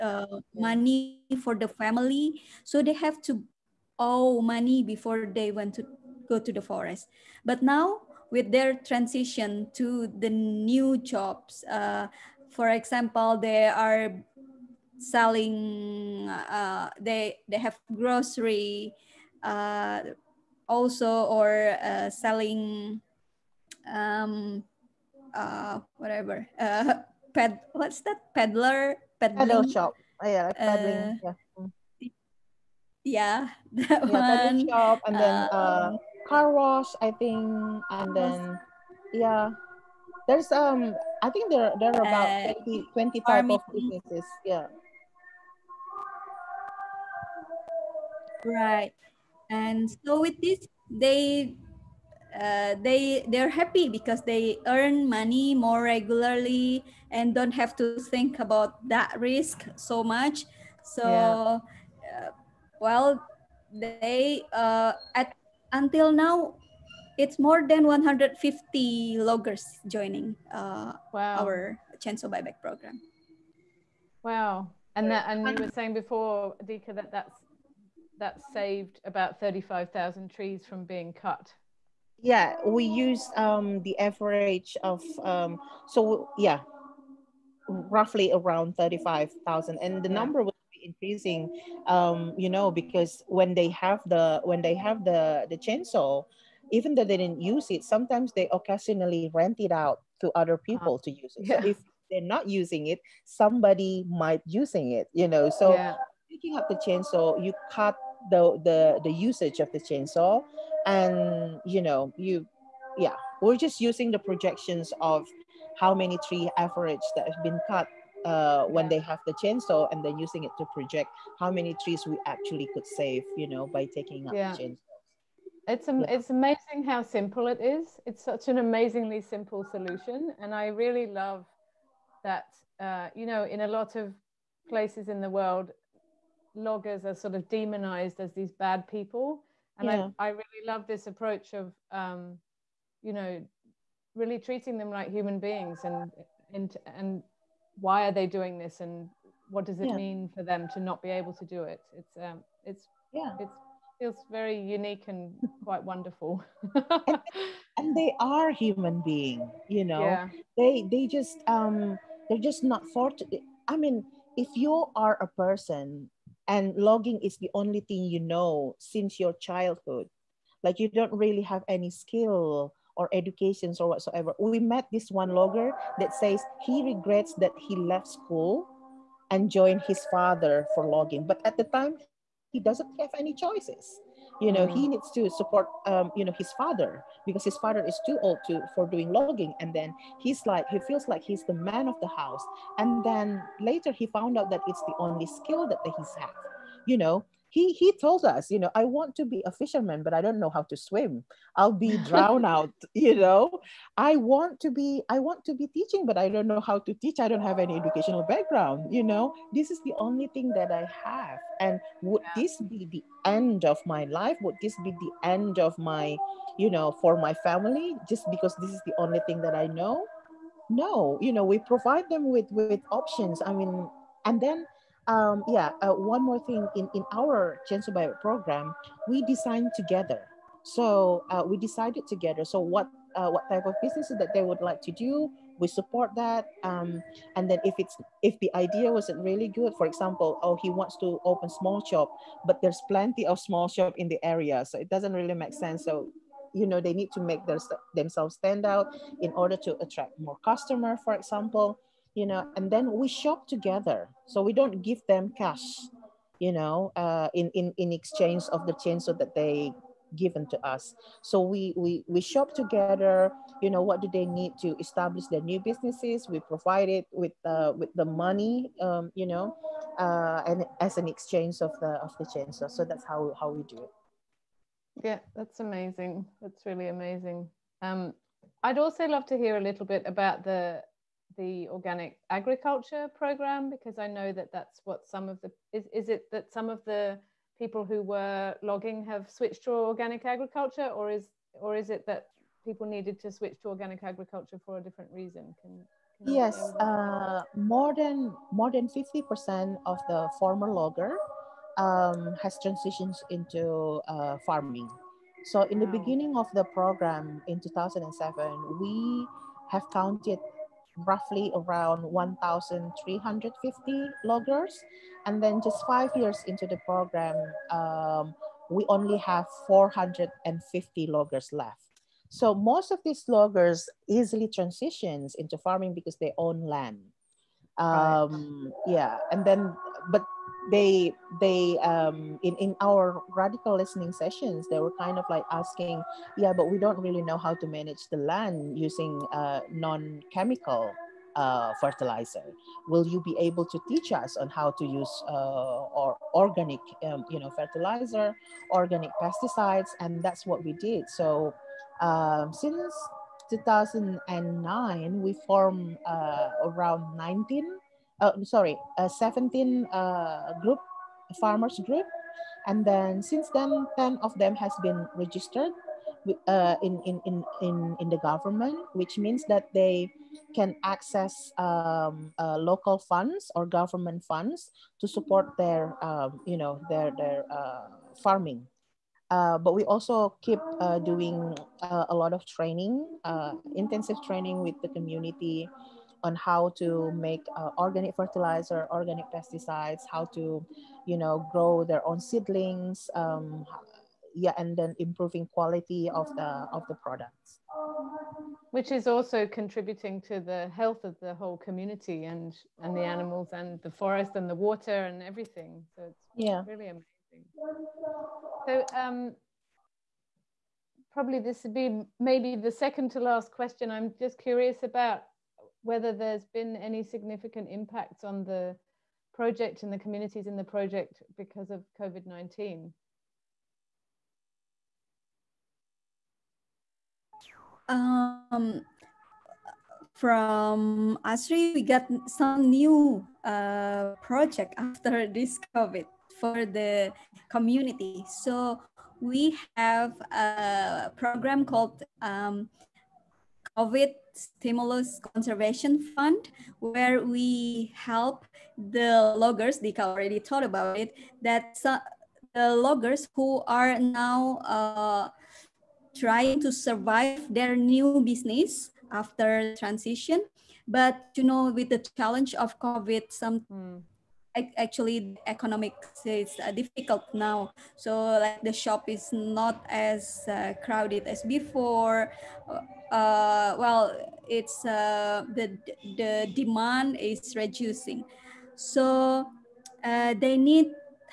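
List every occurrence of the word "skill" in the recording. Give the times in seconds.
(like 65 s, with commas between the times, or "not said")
171 s, 195 s.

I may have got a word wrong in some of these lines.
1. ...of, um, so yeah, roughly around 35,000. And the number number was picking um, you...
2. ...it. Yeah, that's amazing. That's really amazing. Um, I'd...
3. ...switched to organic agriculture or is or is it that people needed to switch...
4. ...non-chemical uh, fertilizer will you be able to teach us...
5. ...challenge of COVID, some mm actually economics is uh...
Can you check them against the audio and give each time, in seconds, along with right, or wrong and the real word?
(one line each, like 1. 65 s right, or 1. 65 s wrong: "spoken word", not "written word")
1. 84 s wrong: "increasing", not "picking"
2. 273 s right
3. 289 s right
4. 339 s right
5. 462 s right.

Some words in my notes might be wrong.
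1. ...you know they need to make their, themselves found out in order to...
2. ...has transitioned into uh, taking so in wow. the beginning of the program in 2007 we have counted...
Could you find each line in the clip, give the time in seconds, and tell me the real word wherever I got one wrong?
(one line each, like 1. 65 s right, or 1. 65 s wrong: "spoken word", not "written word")
1. 246 s wrong: "stand", not "found"
2. 302 s wrong: "farming", not "taking".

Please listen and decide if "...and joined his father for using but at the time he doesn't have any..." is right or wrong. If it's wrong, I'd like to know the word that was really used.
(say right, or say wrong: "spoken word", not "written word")
wrong: "logging", not "using".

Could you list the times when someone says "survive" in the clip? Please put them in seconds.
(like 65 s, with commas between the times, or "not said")
456 s.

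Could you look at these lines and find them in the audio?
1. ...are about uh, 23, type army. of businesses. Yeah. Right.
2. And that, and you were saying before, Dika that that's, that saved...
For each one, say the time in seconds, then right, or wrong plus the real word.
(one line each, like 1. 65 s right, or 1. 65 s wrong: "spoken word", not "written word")
1. 41 s wrong: "20", not "23"
2. 74 s right.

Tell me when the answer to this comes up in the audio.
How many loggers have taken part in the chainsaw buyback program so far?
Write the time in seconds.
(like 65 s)
67 s.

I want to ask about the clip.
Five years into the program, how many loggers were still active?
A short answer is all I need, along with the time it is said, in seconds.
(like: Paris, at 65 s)
450, at 319 s.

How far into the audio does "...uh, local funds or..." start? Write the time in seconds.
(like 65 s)
372 s.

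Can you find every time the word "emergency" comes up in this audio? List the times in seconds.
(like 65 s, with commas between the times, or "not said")
not said.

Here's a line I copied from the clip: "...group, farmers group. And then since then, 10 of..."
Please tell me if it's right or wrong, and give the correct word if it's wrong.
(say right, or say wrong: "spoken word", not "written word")
right.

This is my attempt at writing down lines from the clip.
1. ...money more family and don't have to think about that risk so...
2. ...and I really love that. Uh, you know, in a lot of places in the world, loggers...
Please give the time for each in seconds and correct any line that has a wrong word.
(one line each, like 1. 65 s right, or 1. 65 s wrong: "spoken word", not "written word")
1. 55 s wrong: "regularly", not "family"
2. 130 s right.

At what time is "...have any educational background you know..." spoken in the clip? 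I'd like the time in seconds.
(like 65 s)
207 s.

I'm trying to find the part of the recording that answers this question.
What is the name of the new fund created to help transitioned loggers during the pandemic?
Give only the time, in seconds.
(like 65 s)
443 s.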